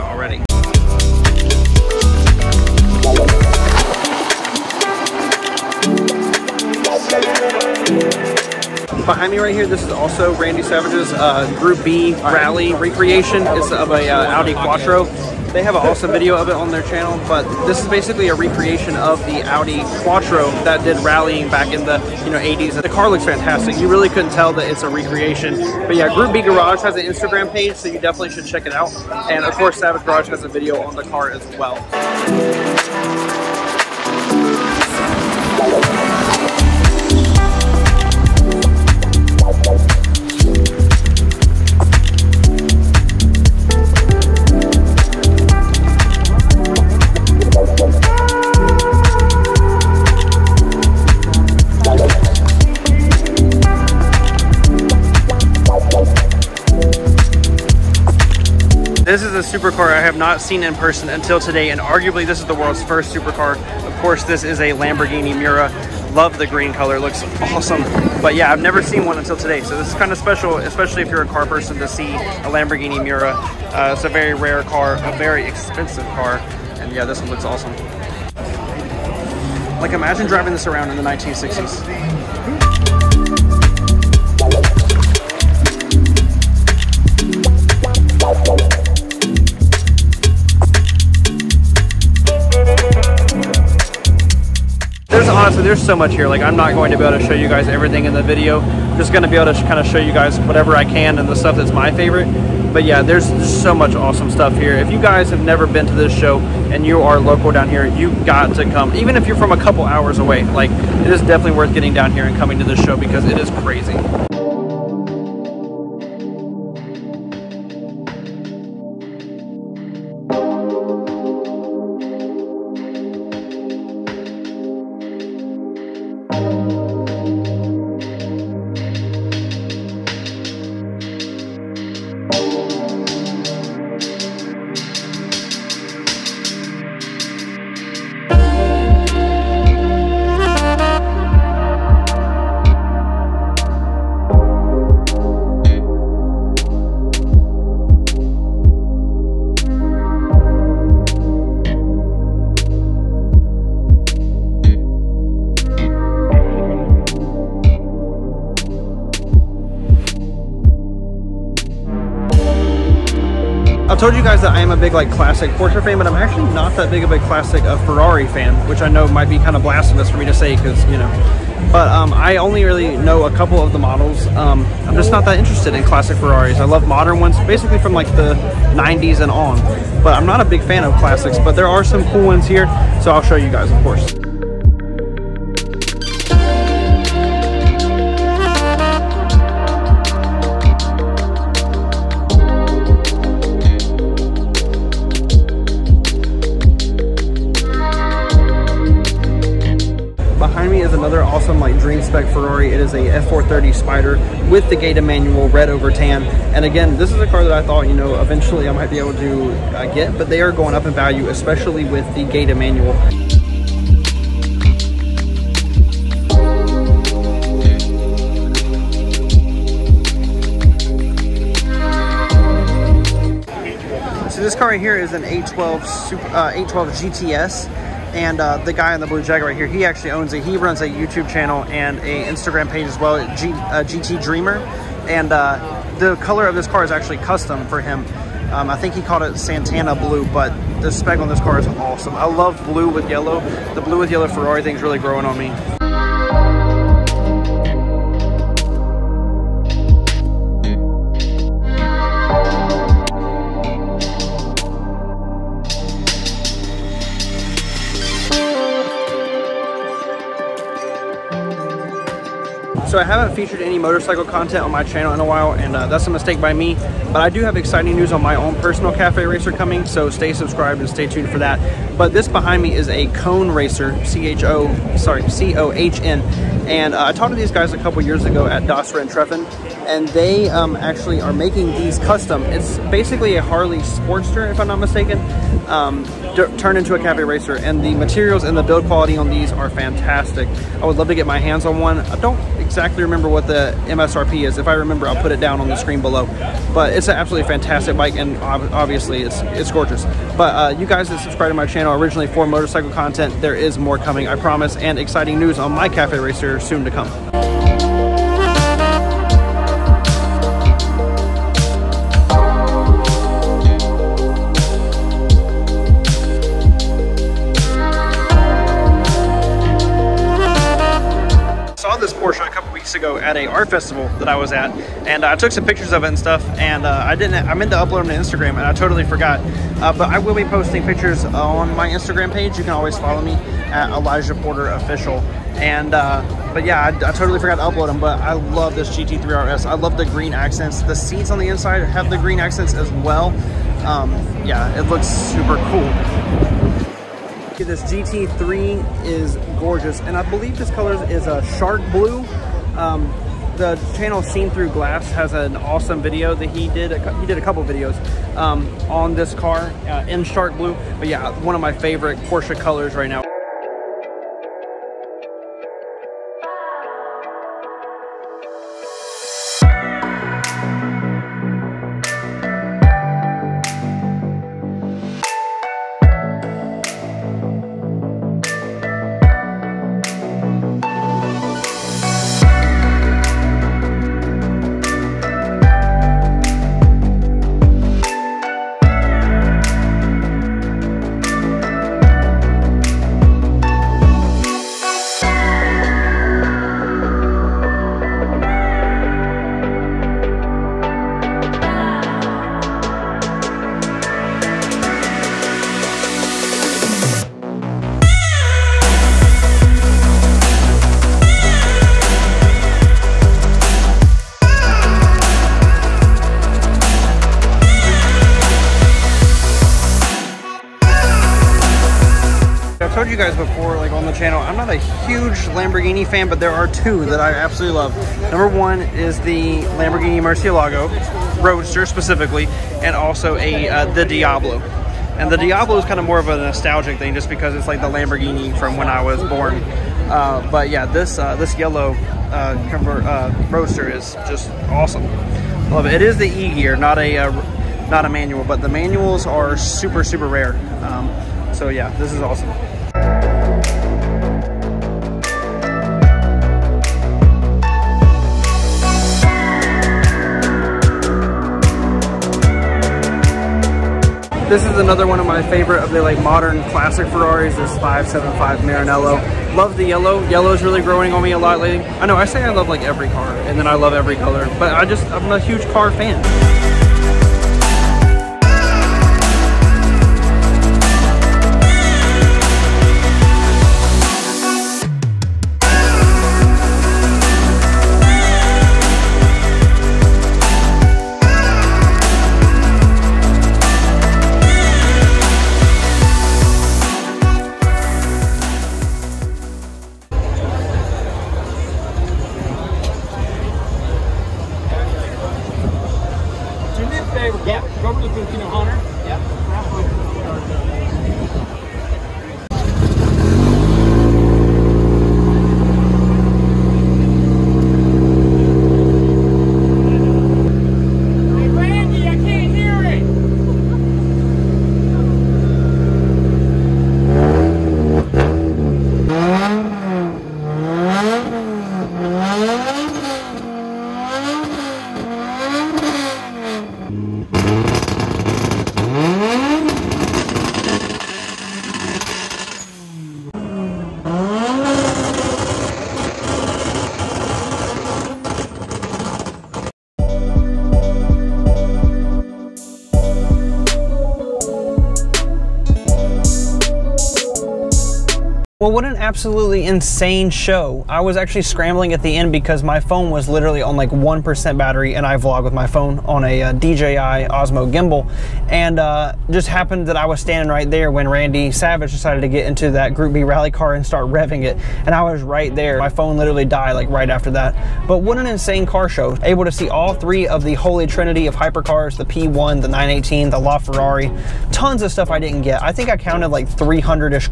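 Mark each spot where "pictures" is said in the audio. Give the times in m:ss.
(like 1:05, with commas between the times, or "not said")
5:25, 5:30.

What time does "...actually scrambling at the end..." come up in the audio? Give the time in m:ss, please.
9:21.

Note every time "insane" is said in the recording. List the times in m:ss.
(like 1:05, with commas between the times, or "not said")
9:19, 9:38.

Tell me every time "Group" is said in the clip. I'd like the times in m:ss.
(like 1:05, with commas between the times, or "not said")
0:11, 0:26, 9:32.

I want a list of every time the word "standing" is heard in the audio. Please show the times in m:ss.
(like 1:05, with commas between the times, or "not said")
9:30.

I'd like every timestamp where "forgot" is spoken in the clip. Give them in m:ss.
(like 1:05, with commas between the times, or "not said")
5:29, 5:37.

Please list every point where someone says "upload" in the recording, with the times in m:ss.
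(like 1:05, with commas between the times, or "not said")
5:27, 5:37.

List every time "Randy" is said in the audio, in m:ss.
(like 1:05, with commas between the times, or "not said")
0:10, 9:31.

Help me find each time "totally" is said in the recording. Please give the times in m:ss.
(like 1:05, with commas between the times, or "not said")
5:28, 5:37.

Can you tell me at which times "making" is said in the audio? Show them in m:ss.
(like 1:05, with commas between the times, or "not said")
4:41.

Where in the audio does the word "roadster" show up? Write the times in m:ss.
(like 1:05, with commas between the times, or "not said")
7:11, 7:23.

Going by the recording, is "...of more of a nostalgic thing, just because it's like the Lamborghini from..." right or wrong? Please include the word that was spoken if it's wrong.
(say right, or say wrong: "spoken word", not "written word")
right.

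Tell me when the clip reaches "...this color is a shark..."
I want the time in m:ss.
5:50.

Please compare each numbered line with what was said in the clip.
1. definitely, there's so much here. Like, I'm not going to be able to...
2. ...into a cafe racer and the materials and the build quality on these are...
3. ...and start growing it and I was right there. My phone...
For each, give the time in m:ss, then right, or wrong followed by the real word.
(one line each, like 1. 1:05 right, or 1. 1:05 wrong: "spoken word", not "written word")
1. 1:35 wrong: "honestly", not "definitely"
2. 4:46 right
3. 9:33 wrong: "revving", not "growing".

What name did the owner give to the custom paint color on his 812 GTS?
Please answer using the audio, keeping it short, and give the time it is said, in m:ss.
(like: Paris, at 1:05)
Santana blue, at 3:59.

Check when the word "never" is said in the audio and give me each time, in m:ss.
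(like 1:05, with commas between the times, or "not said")
1:08, 1:45.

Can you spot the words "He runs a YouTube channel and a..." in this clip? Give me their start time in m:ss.
3:50.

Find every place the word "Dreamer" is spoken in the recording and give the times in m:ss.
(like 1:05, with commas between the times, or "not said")
3:54.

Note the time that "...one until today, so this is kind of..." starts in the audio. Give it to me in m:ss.
1:09.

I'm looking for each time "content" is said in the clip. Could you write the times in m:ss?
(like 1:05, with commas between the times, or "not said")
4:24, 5:02.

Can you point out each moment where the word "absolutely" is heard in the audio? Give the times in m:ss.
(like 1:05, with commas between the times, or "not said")
4:57, 7:07, 9:18.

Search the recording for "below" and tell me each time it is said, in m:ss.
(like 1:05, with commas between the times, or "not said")
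4:56.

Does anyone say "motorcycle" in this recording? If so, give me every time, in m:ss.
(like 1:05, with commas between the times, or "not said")
4:23, 5:02.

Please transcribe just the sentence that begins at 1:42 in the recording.
But yeah, there's just so much awesome stuff here.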